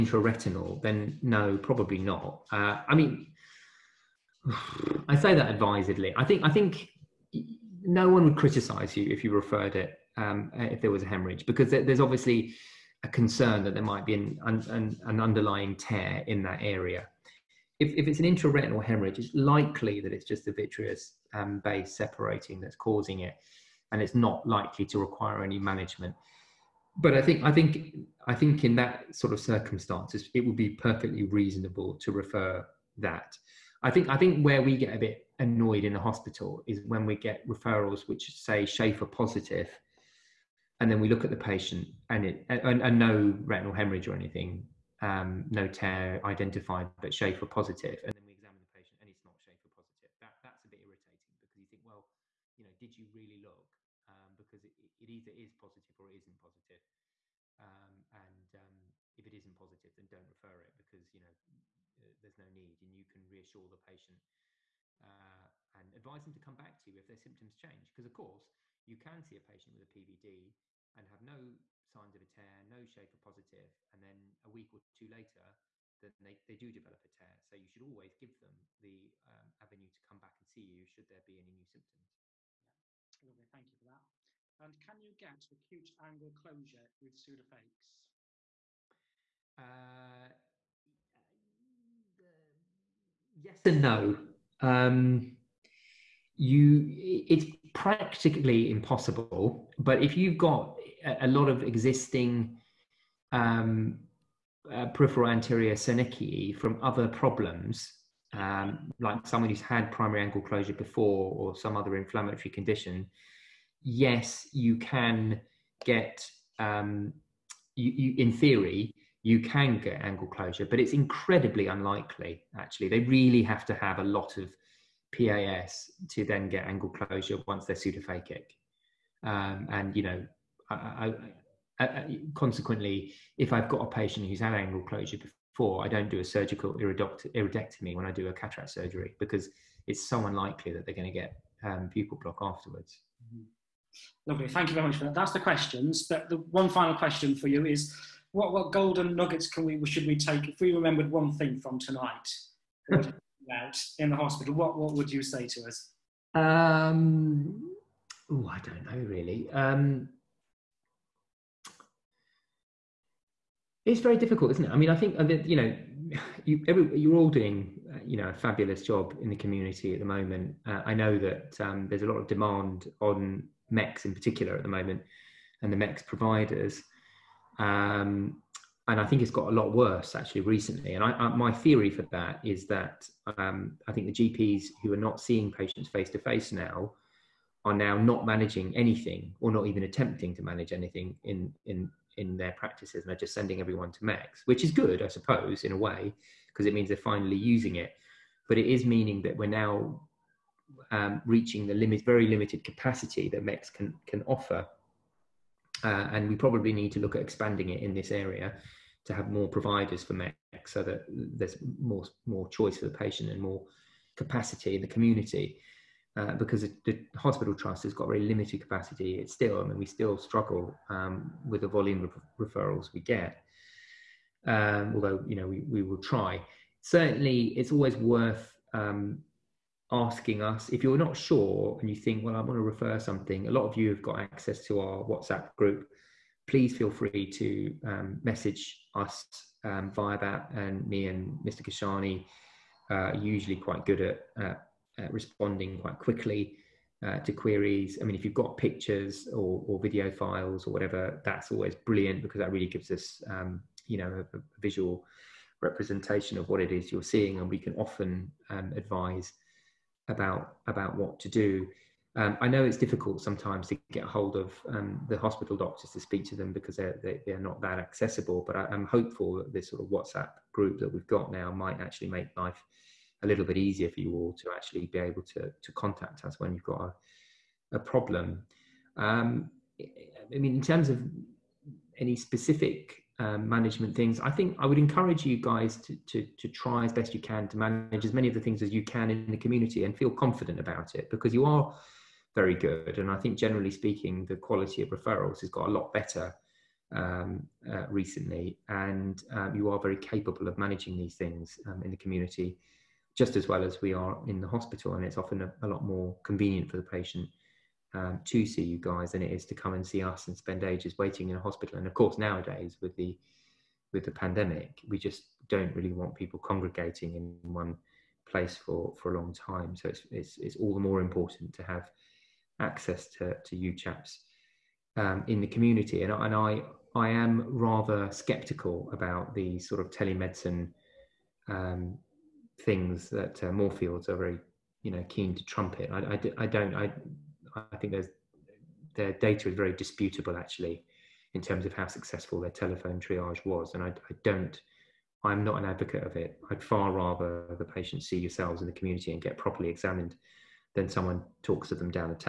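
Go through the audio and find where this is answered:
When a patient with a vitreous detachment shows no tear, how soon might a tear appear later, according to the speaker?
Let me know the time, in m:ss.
1:14.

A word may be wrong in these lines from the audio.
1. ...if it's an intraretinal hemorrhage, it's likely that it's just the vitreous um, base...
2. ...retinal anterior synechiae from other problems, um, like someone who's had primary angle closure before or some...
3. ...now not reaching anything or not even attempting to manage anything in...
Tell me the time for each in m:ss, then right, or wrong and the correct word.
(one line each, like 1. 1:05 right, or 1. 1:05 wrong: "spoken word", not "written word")
1. 0:17 right
2. 1:44 wrong: "peripheral", not "retinal"
3. 3:07 wrong: "managing", not "reaching".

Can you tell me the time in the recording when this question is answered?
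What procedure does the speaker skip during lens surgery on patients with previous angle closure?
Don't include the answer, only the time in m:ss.
2:16.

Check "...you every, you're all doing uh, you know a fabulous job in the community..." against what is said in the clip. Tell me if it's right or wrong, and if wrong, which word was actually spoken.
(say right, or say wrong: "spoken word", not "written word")
right.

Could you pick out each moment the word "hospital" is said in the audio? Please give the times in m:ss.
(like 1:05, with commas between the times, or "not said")
0:36, 2:34, 3:37, 4:25, 5:04, 5:11.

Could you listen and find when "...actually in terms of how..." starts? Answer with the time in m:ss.
5:40.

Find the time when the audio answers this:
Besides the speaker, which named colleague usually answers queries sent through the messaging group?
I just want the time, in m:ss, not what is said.
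4:01.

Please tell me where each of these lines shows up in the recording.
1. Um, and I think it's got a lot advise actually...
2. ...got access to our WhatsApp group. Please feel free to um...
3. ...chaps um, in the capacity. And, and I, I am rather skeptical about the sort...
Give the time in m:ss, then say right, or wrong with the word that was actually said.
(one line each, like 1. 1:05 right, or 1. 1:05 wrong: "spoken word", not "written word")
1. 2:57 wrong: "worse", not "advise"
2. 3:54 right
3. 5:23 wrong: "community", not "capacity".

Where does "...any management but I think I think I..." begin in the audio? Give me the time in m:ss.
0:25.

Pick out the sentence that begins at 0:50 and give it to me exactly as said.
That that's a bit irritating because you think, well, you know, did you really look?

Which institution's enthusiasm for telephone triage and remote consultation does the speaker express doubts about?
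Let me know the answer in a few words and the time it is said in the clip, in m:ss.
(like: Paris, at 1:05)
Moorfields, at 5:33.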